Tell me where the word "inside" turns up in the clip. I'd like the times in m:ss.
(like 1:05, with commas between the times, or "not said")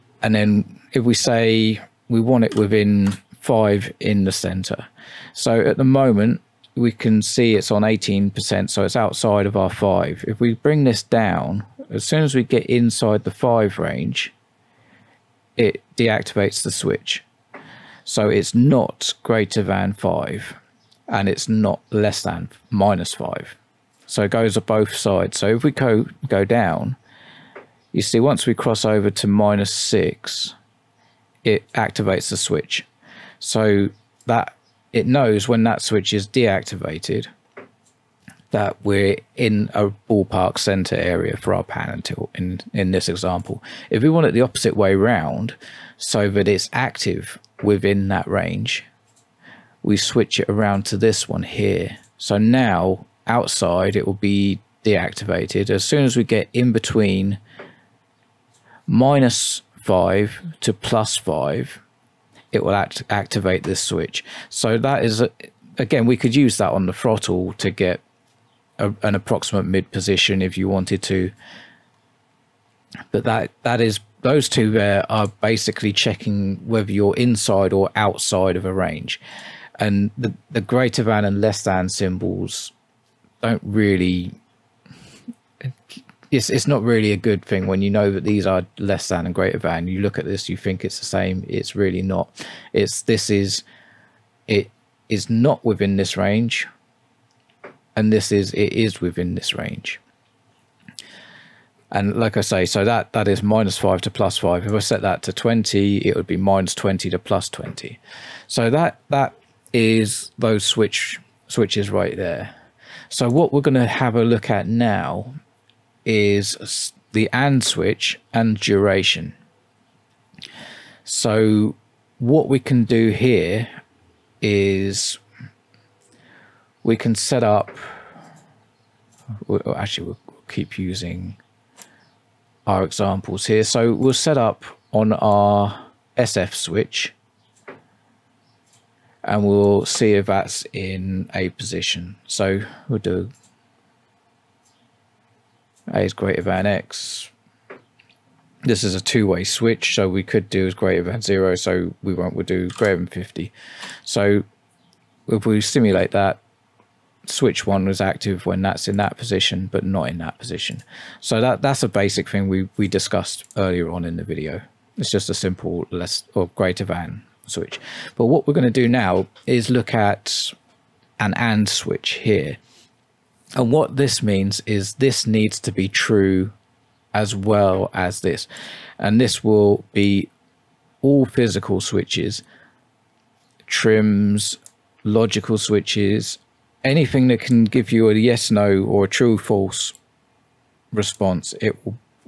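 0:12, 1:17.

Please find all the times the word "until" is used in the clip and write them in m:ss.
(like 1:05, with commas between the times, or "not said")
0:41.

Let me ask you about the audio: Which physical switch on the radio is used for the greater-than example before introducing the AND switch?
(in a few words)
SF.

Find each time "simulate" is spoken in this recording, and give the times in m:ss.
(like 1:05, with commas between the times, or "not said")
2:35.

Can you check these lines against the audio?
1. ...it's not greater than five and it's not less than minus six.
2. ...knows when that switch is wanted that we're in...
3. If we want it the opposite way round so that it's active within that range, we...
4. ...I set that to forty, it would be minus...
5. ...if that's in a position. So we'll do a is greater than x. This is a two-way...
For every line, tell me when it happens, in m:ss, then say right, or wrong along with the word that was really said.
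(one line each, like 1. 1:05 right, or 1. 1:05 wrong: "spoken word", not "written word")
1. 0:18 wrong: "five", not "six"
2. 0:35 wrong: "deactivated", not "wanted"
3. 0:43 right
4. 1:44 wrong: "twenty", not "forty"
5. 2:20 right.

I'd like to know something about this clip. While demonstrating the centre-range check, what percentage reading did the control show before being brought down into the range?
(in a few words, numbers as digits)
18%.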